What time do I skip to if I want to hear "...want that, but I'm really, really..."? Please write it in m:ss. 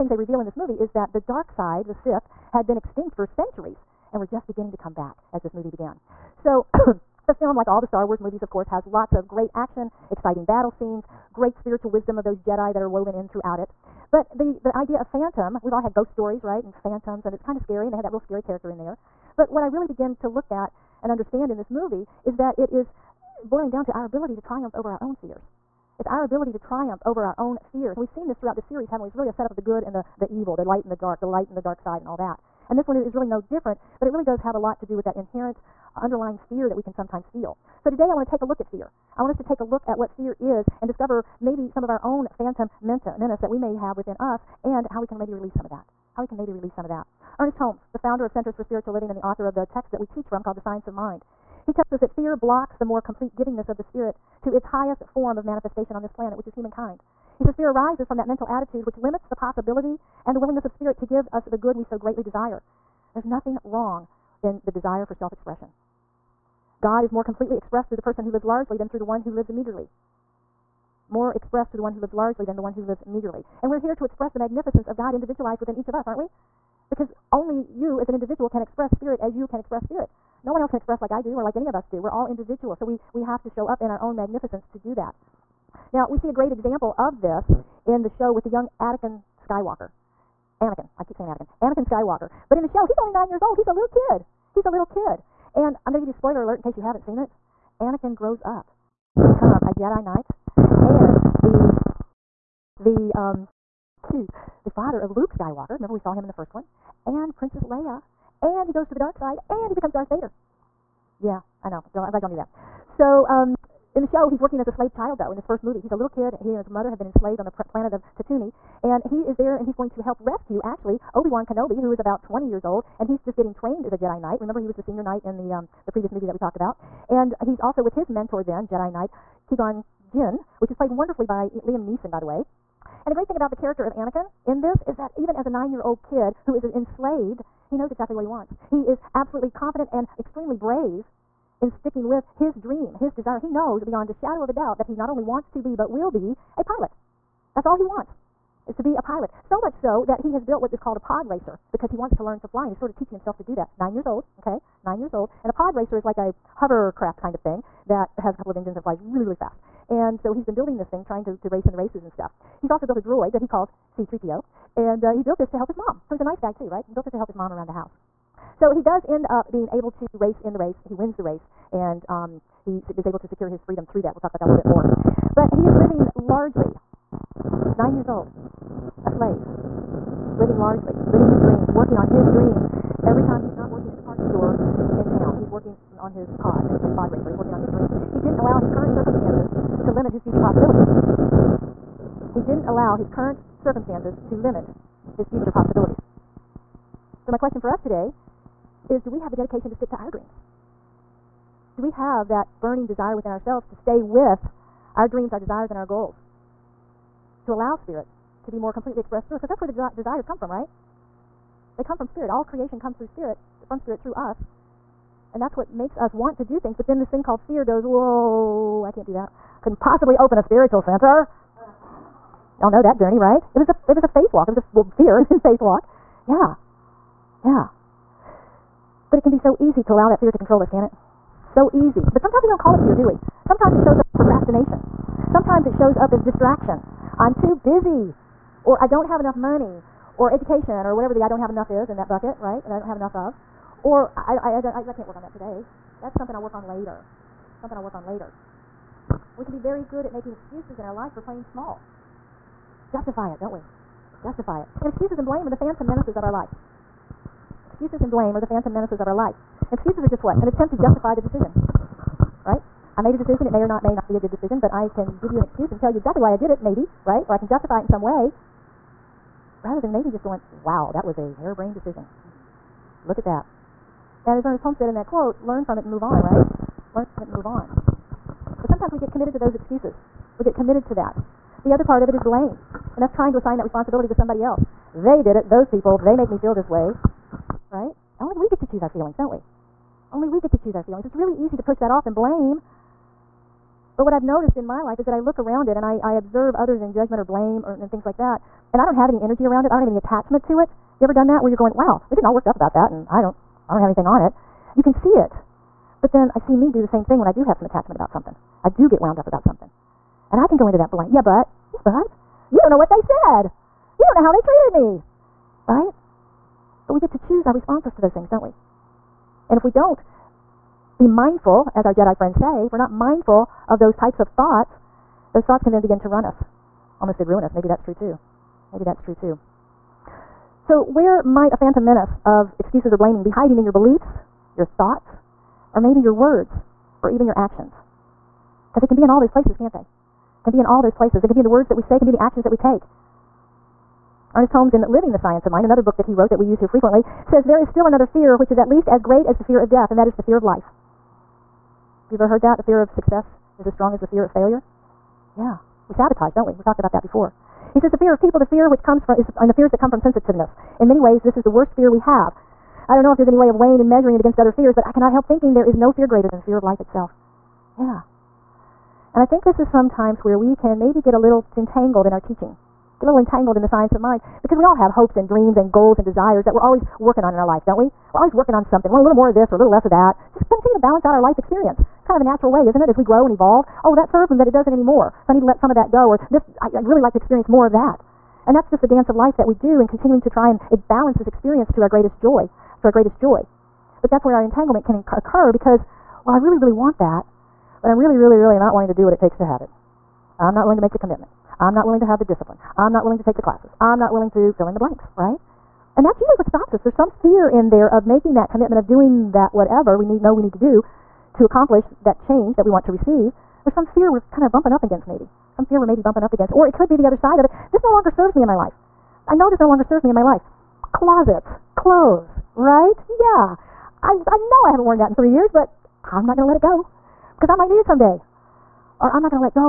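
6:36.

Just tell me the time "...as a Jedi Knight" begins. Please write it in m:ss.
2:03.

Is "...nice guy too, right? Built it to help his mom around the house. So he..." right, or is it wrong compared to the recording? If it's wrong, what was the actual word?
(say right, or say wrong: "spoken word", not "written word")
right.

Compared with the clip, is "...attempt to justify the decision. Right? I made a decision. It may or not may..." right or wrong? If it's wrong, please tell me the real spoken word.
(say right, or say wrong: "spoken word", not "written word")
right.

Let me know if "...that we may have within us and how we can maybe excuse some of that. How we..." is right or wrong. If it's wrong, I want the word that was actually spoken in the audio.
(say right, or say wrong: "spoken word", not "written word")
wrong: "release", not "excuse".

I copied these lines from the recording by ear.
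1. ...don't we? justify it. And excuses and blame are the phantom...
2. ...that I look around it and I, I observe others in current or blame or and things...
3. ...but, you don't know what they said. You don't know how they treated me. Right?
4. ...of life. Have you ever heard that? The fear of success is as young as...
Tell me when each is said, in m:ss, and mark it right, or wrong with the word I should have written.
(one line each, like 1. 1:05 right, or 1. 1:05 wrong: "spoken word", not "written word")
1. 4:13 right
2. 4:55 wrong: "judgment", not "current"
3. 5:11 right
4. 5:50 wrong: "strong", not "young".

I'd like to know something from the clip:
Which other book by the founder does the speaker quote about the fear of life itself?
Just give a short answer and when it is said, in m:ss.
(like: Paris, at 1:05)
Living the Science of Mind, at 5:44.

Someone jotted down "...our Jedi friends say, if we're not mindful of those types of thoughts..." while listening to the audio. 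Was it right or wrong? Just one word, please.
right.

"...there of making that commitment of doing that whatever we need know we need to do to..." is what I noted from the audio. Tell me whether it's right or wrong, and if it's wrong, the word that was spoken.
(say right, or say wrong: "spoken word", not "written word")
right.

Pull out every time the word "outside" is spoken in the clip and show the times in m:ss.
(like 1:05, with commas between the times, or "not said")
not said.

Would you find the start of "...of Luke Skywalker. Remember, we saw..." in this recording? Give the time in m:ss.
1:44.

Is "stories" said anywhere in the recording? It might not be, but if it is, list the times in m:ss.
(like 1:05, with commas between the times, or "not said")
0:16.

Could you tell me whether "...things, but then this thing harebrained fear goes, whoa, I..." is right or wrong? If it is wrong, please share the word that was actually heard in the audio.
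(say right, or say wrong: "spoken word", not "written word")
wrong: "called", not "harebrained".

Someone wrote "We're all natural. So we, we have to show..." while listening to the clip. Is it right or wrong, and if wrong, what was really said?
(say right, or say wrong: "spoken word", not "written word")
wrong: "individual", not "natural".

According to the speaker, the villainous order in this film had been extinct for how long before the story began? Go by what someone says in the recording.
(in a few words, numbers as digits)
centuries.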